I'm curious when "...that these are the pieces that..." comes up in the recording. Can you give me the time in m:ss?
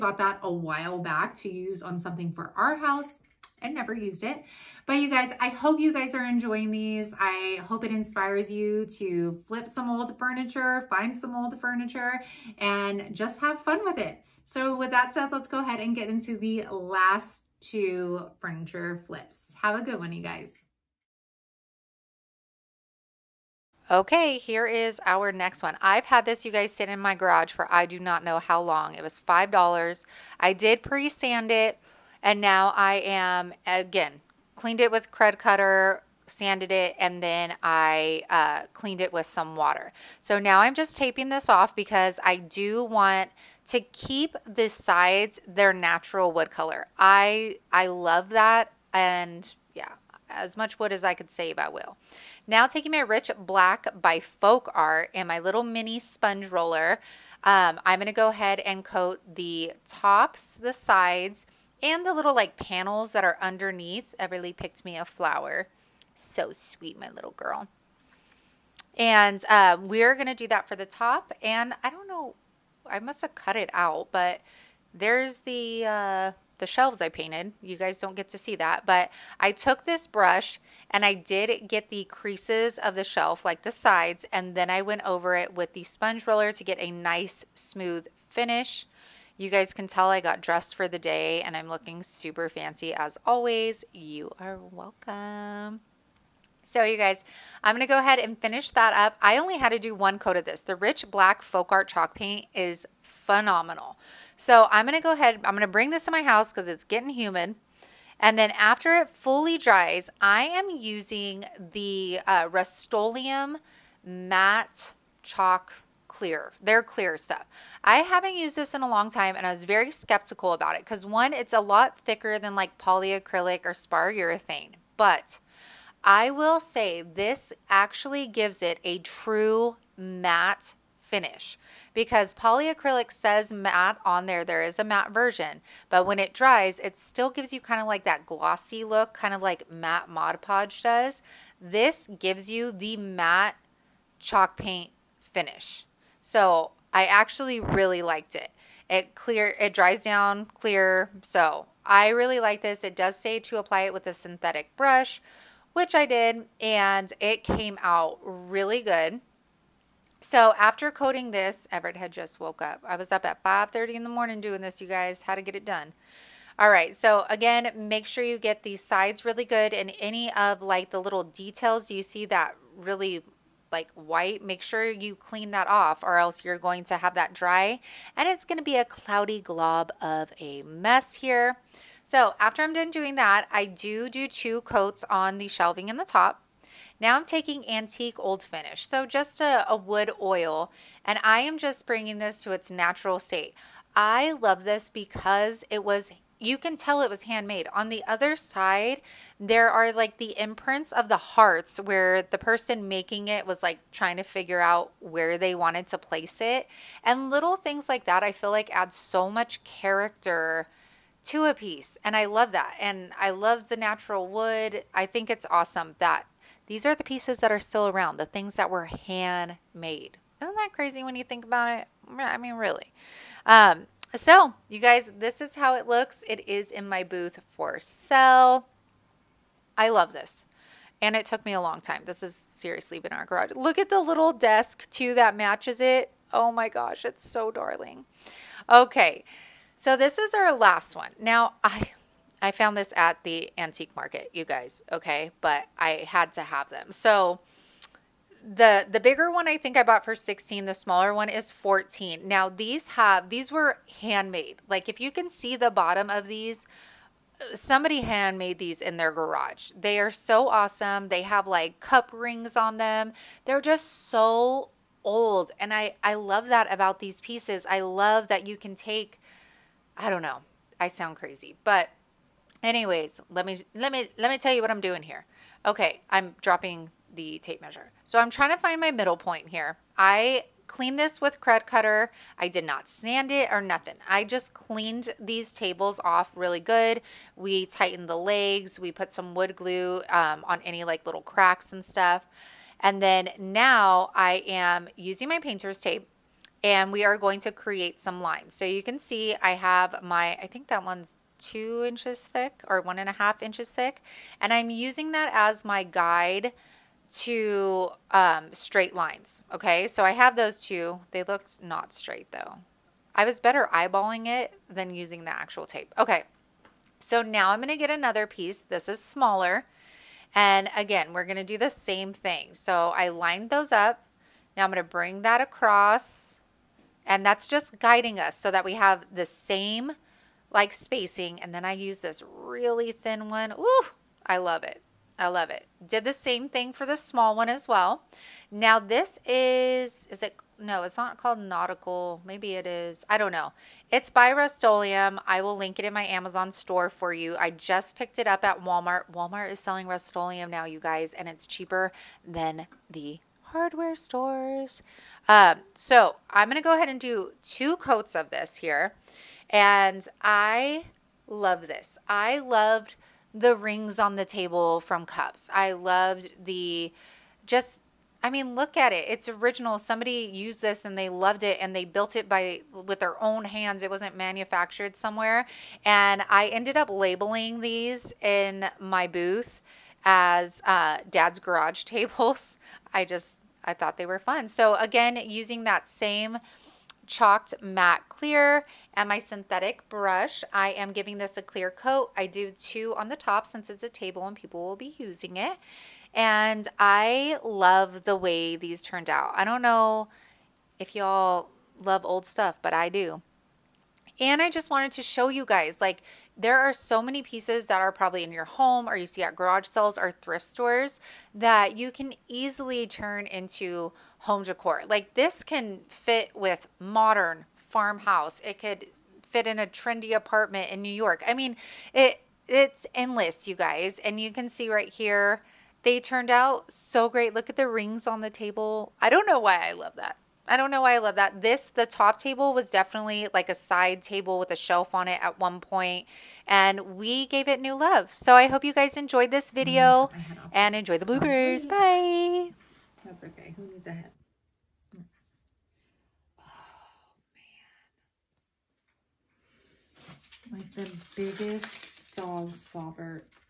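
3:35.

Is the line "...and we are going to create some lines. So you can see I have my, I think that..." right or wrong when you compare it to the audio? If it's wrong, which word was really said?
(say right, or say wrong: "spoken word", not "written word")
right.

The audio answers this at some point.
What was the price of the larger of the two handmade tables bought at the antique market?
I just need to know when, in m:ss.
4:10.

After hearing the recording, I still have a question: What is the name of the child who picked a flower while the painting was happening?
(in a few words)
Everly.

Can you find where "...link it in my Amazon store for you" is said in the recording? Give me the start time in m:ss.
5:45.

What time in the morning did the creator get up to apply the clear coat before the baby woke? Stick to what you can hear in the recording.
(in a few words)
5:30.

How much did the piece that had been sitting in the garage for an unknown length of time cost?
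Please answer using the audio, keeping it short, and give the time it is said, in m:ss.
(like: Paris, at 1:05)
$5, at 0:29.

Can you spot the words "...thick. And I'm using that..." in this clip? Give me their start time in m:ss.
5:03.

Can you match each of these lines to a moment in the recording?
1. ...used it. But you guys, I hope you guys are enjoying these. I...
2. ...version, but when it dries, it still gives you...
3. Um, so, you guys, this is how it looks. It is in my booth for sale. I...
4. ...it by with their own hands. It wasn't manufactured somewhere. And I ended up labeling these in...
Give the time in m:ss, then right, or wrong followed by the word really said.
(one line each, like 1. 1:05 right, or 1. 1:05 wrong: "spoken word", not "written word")
1. 0:03 right
2. 2:15 right
3. 3:43 right
4. 6:12 right.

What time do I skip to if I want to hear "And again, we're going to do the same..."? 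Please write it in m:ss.
5:20.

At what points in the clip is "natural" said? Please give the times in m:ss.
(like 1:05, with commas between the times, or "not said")
0:45, 3:12, 3:33.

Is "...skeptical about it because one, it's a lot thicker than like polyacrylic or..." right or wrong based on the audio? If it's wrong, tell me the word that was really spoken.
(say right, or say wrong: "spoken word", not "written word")
right.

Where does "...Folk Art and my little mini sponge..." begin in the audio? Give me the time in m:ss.
0:54.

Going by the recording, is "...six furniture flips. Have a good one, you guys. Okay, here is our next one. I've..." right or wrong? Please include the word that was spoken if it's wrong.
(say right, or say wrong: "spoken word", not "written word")
wrong: "two", not "six".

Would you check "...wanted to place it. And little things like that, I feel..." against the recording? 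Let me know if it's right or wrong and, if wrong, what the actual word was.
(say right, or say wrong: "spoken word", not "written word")
right.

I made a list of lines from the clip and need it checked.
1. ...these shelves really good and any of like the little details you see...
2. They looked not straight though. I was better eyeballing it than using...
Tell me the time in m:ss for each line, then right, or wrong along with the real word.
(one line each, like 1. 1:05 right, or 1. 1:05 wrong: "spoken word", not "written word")
1. 2:48 wrong: "sides", not "shelves"
2. 5:11 right.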